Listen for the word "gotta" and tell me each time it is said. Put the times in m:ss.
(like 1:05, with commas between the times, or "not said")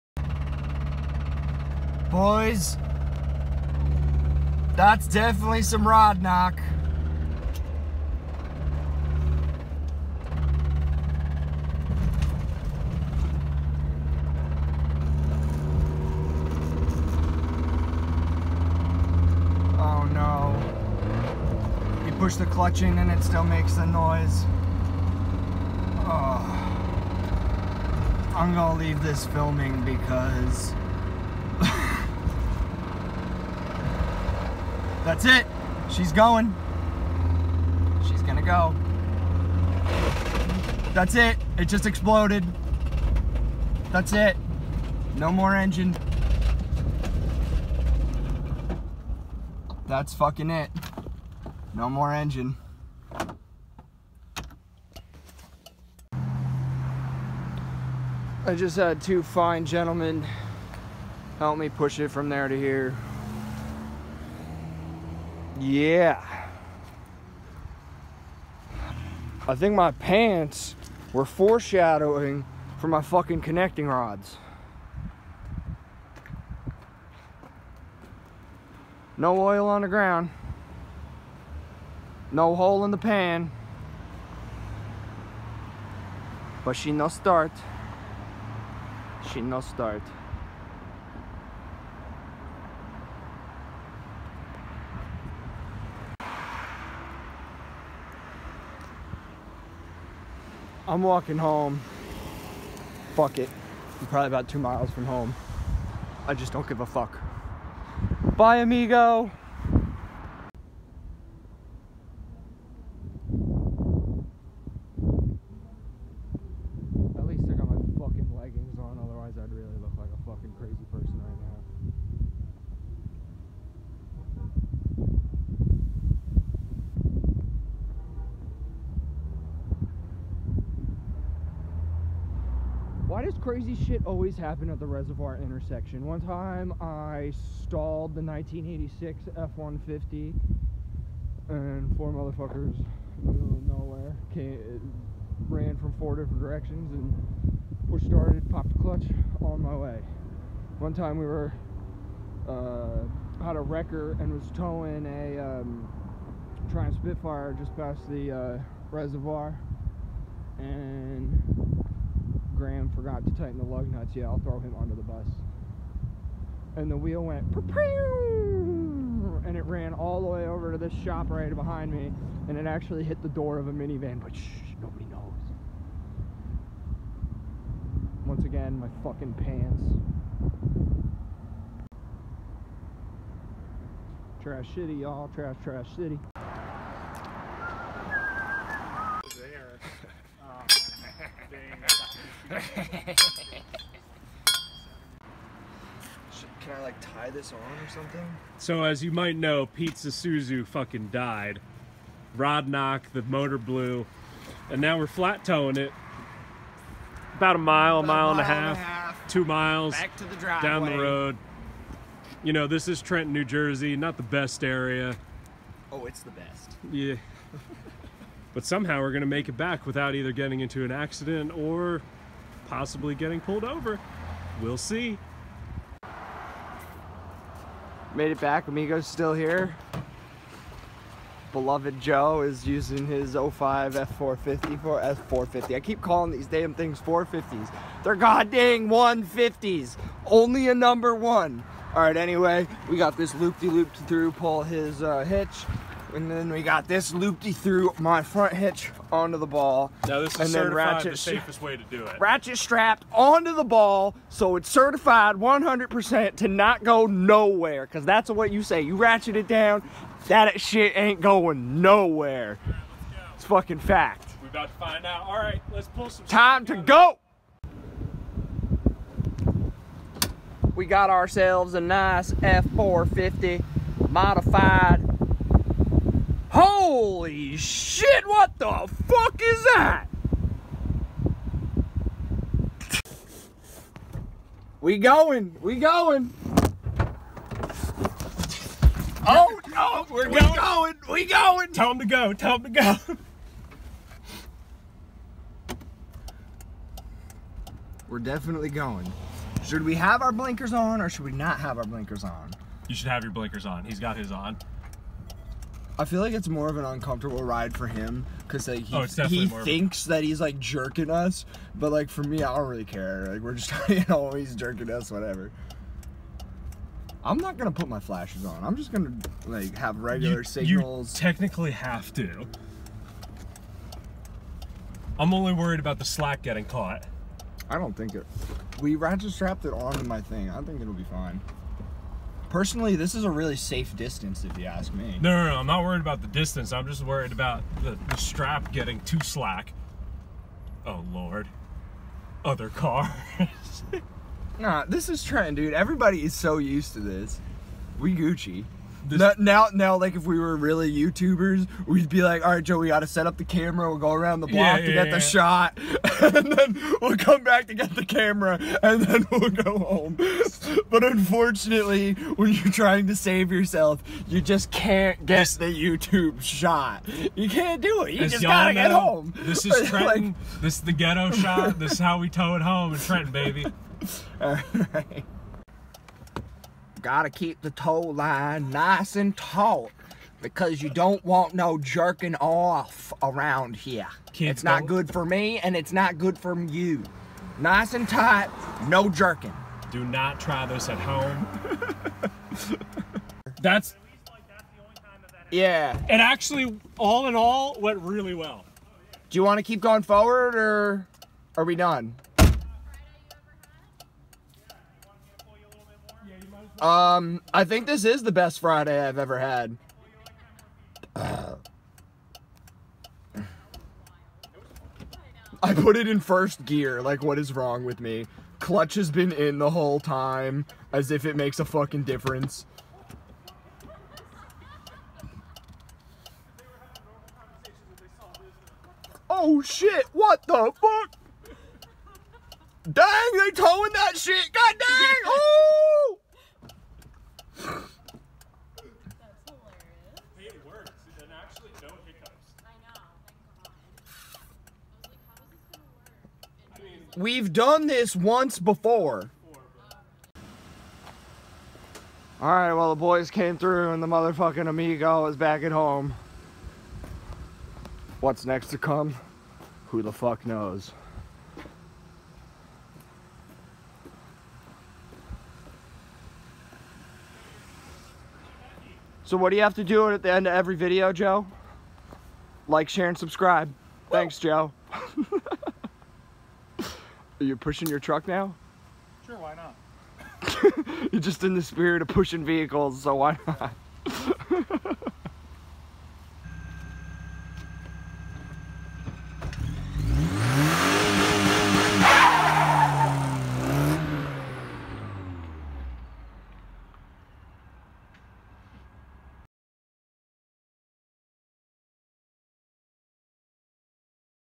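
6:08, 6:17.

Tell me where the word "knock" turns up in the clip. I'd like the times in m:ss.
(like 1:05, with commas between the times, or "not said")
0:06, 3:22.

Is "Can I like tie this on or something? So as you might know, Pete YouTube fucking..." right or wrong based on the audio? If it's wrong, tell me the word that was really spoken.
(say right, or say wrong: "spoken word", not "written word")
wrong: "Suzu", not "YouTube".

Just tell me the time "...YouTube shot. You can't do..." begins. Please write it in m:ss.
6:05.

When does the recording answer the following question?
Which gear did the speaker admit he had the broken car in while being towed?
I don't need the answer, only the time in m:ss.
6:56.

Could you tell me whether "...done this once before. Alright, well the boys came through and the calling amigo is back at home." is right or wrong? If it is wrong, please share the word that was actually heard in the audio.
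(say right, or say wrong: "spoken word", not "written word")
wrong: "motherfucking", not "calling".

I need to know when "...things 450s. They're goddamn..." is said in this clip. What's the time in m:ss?
3:56.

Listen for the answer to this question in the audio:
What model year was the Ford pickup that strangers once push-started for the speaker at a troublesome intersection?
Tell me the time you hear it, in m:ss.
2:18.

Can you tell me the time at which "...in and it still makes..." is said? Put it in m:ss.
0:22.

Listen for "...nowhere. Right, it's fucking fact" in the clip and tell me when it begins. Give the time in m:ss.
4:21.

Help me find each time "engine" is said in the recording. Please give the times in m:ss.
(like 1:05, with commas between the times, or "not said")
0:45, 0:52.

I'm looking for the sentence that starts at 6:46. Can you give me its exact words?
Um, I think this is the best Friday I've ever had.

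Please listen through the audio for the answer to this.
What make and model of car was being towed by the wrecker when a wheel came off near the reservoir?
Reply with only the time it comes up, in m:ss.
2:36.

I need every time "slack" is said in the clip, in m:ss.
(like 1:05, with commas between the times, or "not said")
5:26, 5:39.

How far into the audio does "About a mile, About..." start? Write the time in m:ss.
3:27.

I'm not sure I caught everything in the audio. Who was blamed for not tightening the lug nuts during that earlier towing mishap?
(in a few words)
Graham.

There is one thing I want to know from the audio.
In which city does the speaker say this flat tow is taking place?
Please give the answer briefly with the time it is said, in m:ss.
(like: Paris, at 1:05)
Trenton, New Jersey, at 3:33.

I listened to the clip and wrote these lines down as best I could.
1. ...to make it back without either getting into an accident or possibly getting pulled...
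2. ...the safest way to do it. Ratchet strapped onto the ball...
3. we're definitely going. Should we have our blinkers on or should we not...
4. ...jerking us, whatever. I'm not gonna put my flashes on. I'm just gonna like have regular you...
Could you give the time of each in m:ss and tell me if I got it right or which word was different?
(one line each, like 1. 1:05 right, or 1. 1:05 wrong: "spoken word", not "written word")
1. 3:39 right
2. 4:11 right
3. 4:58 right
4. 5:14 right.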